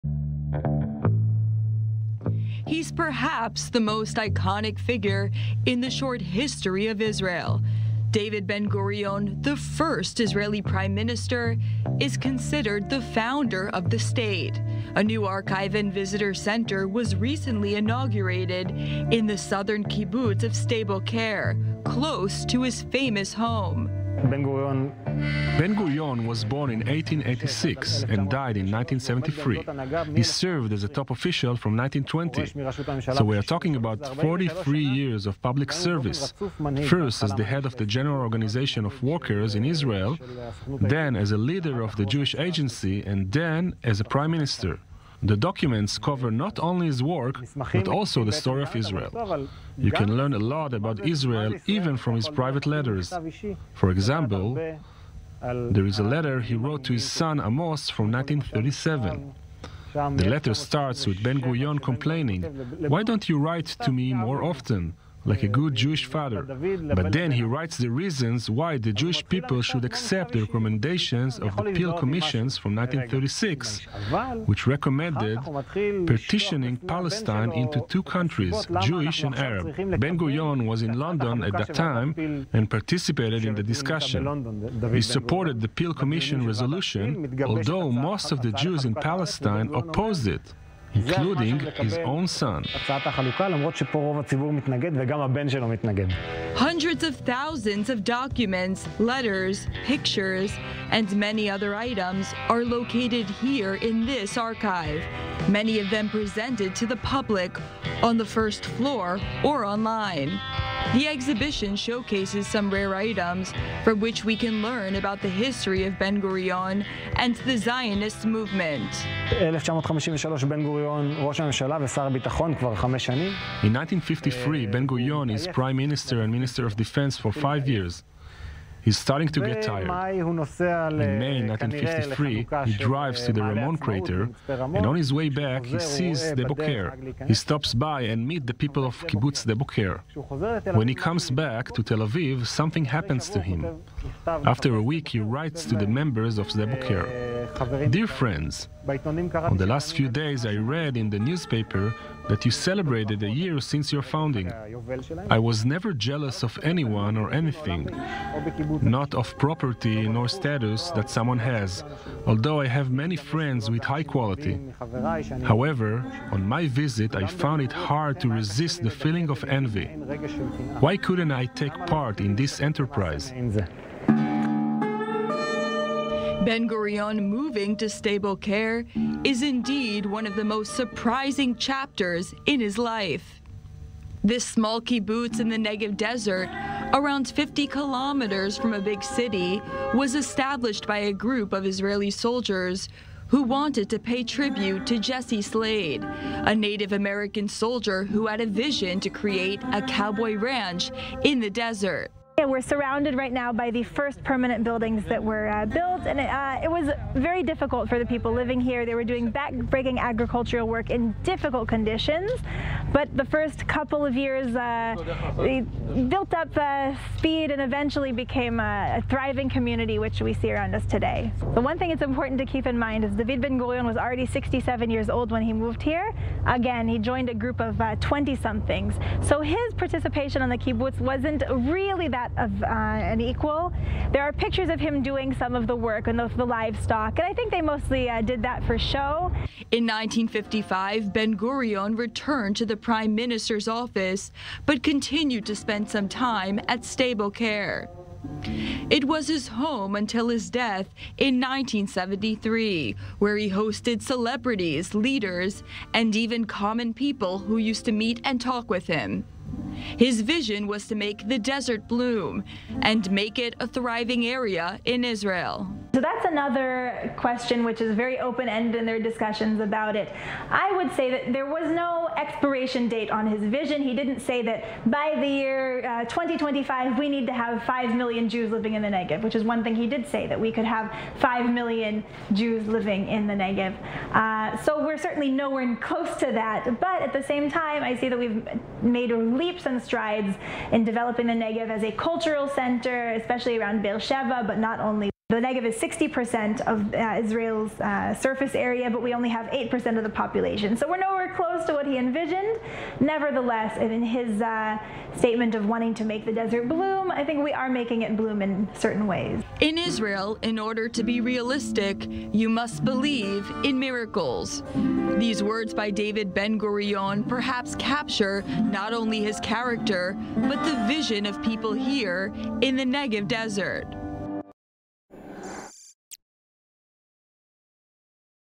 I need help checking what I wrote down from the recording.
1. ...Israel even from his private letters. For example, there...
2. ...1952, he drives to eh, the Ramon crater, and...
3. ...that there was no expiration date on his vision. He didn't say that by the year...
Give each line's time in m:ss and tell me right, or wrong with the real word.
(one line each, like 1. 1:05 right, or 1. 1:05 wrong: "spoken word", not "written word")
1. 0:51 right
2. 2:11 wrong: "1953", not "1952"
3. 4:31 right.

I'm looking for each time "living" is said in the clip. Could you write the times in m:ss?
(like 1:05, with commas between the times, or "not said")
3:28, 4:38, 4:42.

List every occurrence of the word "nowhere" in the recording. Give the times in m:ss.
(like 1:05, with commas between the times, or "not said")
4:45, 5:00.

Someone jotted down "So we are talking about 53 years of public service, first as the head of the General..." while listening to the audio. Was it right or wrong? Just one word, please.
wrong.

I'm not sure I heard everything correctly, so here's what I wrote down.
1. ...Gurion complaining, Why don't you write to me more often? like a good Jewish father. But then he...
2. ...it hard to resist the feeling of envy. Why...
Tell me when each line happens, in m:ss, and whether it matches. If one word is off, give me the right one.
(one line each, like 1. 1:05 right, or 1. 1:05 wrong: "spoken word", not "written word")
1. 1:01 right
2. 2:47 right.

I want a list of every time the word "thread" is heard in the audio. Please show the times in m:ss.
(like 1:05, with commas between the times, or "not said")
not said.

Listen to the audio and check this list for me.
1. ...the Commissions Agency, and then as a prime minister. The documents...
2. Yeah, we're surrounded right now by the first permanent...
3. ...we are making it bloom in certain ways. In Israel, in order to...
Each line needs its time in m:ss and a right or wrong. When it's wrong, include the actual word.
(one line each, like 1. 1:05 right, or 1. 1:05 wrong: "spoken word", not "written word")
1. 0:41 wrong: "Jewish", not "Commissions"
2. 3:22 right
3. 5:07 right.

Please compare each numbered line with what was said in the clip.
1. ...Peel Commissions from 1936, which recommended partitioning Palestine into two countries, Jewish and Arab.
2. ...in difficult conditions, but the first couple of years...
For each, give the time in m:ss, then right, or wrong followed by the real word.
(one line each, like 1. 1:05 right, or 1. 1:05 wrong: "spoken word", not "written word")
1. 1:11 right
2. 3:30 right.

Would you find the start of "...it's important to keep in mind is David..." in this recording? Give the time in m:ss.
3:41.